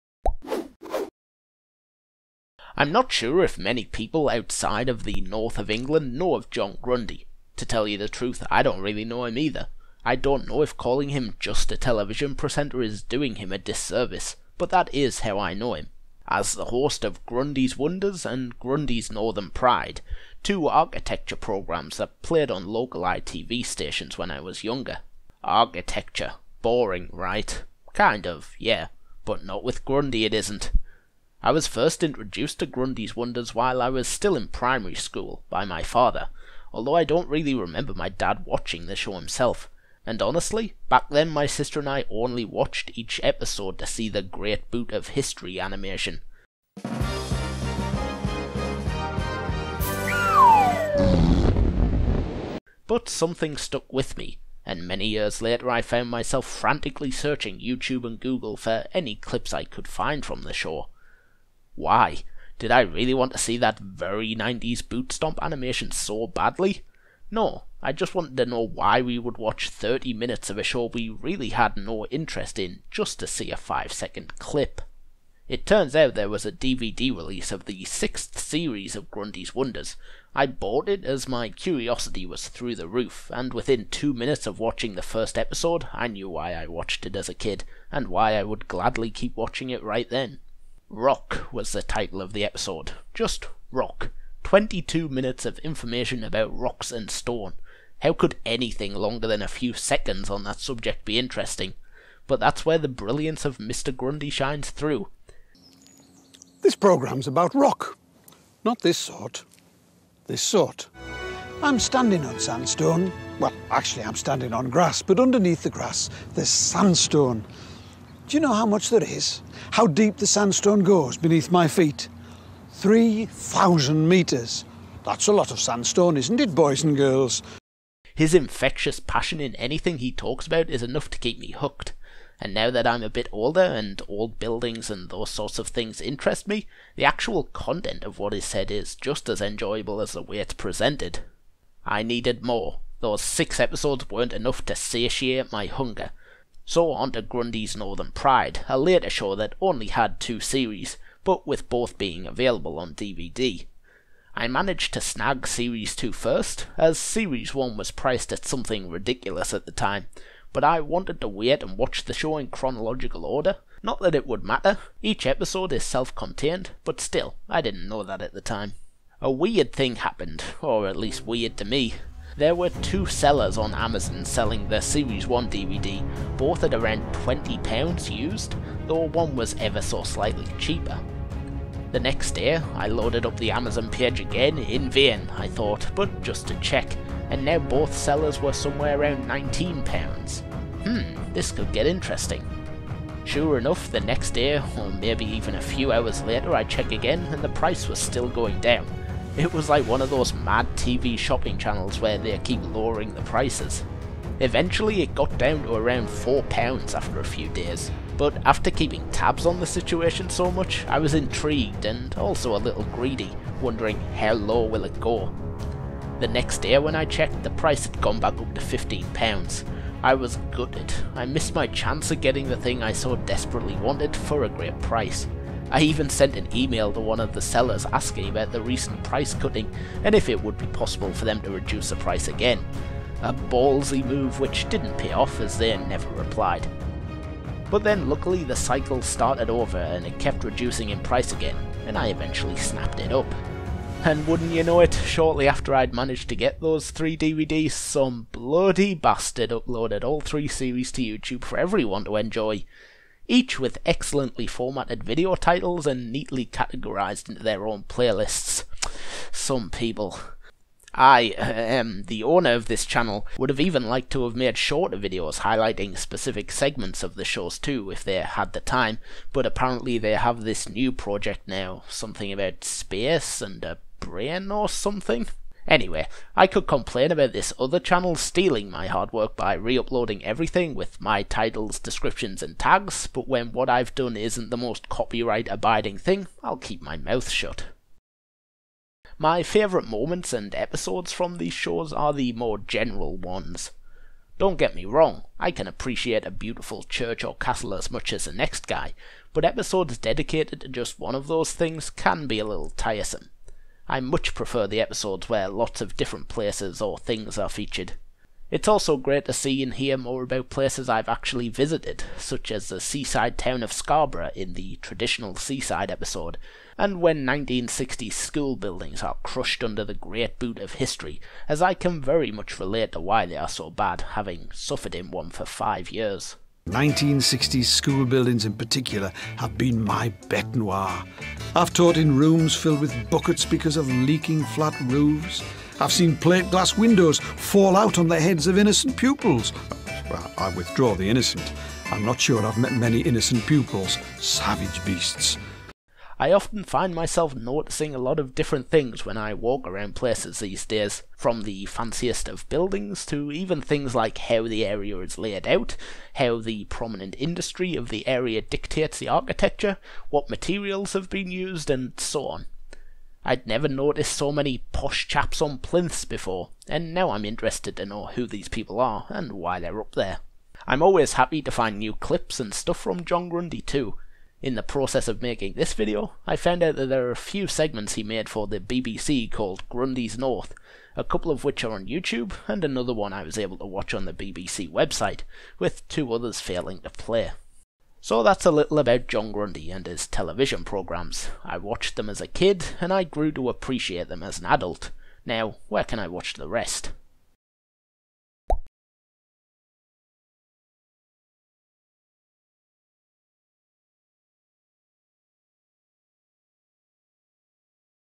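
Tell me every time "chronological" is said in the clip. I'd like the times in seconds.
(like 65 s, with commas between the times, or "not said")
162 s.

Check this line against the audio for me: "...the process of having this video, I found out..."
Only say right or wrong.
wrong.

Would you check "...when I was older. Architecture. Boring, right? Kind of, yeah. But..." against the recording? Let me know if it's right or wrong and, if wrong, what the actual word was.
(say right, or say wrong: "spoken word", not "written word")
wrong: "younger", not "older".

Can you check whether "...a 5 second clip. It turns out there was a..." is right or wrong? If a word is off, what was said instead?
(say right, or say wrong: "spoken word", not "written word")
right.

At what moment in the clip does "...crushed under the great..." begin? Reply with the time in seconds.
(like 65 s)
319 s.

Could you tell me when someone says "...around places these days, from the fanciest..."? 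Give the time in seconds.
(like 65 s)
349 s.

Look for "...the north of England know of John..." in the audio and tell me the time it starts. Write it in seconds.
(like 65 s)
5 s.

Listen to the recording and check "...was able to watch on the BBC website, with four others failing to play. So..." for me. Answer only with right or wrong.
wrong.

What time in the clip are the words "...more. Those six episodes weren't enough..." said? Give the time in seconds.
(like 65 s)
142 s.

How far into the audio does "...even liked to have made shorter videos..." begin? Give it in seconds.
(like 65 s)
263 s.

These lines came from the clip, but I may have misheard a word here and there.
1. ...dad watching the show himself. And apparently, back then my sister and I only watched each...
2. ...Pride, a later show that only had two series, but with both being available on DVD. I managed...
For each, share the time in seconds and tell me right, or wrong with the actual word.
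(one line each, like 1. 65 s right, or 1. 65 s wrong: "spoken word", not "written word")
1. 38 s wrong: "honestly", not "apparently"
2. 148 s right.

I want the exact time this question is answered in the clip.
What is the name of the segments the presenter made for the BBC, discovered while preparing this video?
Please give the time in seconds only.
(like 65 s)
379 s.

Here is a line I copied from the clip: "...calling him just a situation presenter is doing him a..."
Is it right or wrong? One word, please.
wrong.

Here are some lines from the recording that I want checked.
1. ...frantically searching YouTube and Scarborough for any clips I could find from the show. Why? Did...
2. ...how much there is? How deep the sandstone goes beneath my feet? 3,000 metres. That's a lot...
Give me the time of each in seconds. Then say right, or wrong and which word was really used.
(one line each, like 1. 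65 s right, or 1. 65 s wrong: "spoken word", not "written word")
1. 56 s wrong: "Google", not "Scarborough"
2. 118 s right.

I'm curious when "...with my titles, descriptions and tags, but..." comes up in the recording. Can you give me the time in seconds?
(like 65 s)
280 s.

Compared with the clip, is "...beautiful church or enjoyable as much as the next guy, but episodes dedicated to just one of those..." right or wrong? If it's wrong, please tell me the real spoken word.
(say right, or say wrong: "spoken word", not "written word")
wrong: "castle", not "enjoyable".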